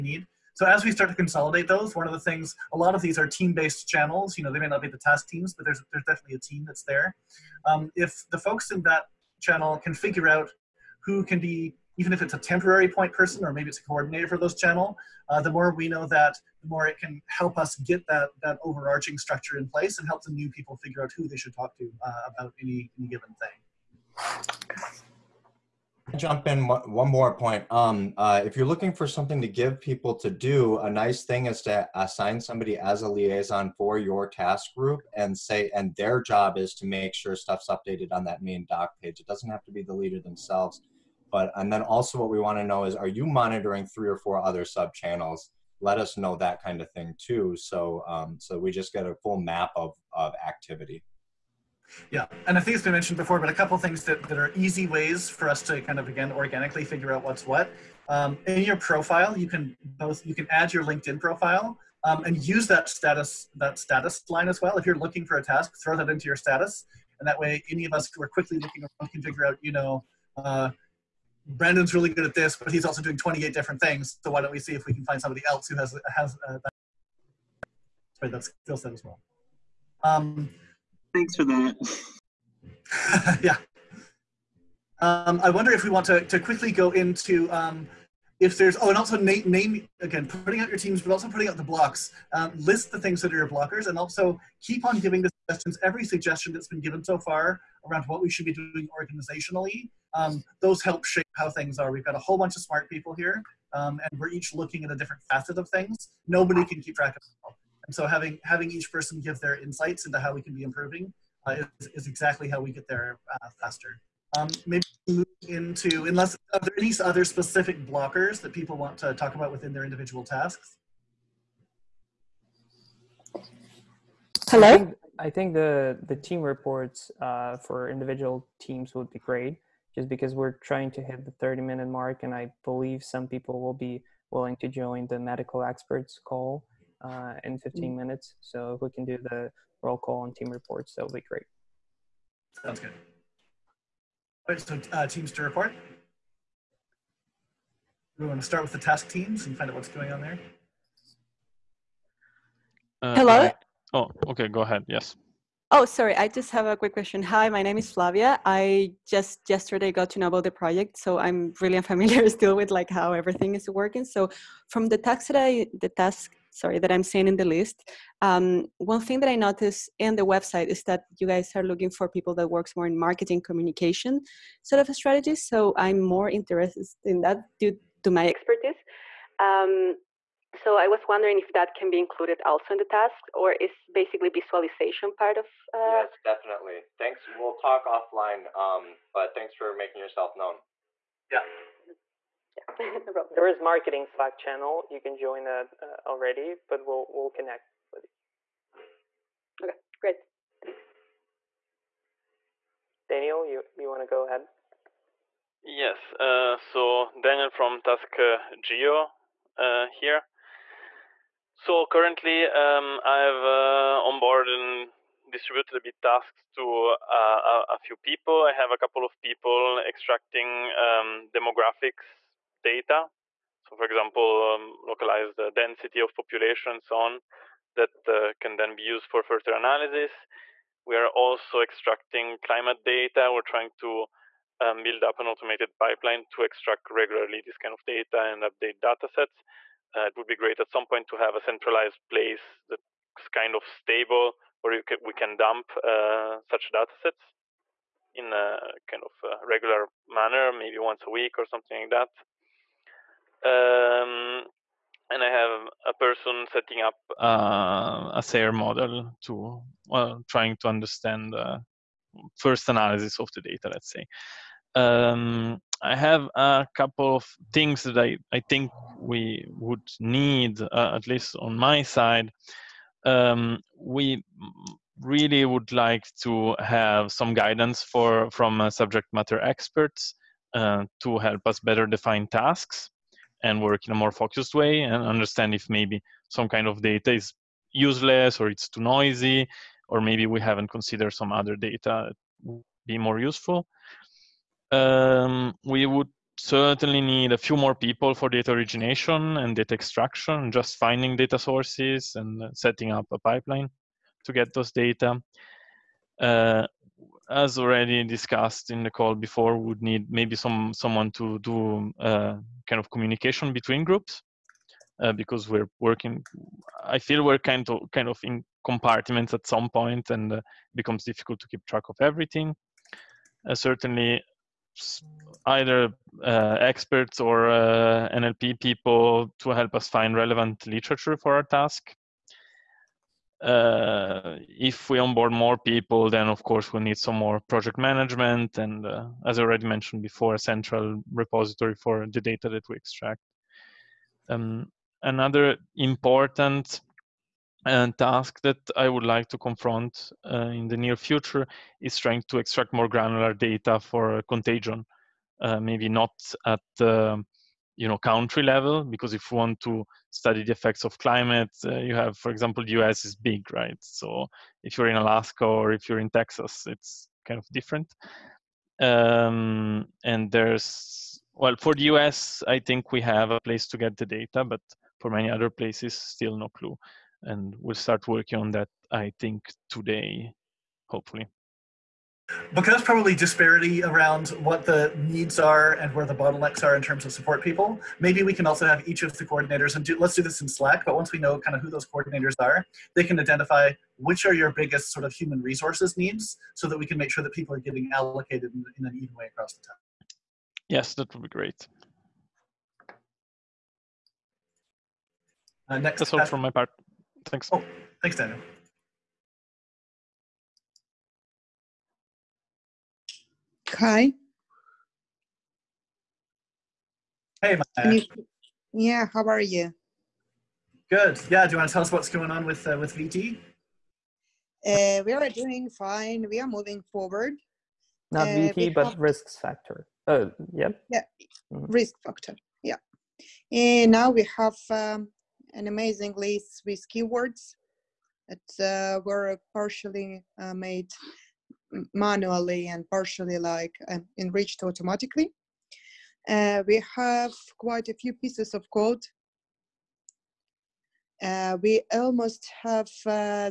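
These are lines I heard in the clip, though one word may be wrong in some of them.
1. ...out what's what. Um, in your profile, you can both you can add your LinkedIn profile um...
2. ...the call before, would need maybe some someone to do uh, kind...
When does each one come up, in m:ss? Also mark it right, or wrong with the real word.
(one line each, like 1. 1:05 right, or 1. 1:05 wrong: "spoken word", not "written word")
1. 0:57 right
2. 5:08 right.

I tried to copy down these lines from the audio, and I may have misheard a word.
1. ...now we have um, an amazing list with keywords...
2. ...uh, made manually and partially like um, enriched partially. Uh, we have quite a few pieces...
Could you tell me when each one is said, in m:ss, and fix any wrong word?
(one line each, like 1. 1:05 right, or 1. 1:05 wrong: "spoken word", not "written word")
1. 7:13 right
2. 7:20 wrong: "automatically", not "partially".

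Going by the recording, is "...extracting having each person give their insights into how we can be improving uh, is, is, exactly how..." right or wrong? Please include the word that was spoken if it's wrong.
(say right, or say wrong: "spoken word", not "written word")
wrong: "having", not "extracting".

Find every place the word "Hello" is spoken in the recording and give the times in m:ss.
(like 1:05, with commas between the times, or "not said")
2:04, 2:33.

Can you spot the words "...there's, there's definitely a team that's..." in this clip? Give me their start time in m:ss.
0:05.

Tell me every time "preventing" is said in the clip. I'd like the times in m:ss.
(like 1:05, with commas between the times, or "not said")
not said.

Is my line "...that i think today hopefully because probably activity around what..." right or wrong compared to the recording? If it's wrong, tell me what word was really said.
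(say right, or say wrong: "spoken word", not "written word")
wrong: "disparity", not "activity".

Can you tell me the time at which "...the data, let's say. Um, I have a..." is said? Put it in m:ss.
4:23.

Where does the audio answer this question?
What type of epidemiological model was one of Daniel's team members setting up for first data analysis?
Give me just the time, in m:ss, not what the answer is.
4:18.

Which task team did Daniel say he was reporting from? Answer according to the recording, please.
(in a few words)
geo.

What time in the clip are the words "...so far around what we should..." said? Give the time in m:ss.
1:37.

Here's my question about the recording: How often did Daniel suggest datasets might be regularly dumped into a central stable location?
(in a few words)
once a week.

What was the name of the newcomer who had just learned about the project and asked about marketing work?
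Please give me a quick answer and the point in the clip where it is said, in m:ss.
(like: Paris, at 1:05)
Flavia, at 2:37.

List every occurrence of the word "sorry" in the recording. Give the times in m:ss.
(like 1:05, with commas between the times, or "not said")
2:35, 2:46.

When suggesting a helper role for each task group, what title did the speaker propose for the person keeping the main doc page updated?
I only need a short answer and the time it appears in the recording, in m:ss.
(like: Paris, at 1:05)
liaison, at 0:33.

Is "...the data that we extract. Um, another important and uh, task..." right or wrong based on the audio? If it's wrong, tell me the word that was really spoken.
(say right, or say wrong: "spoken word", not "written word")
right.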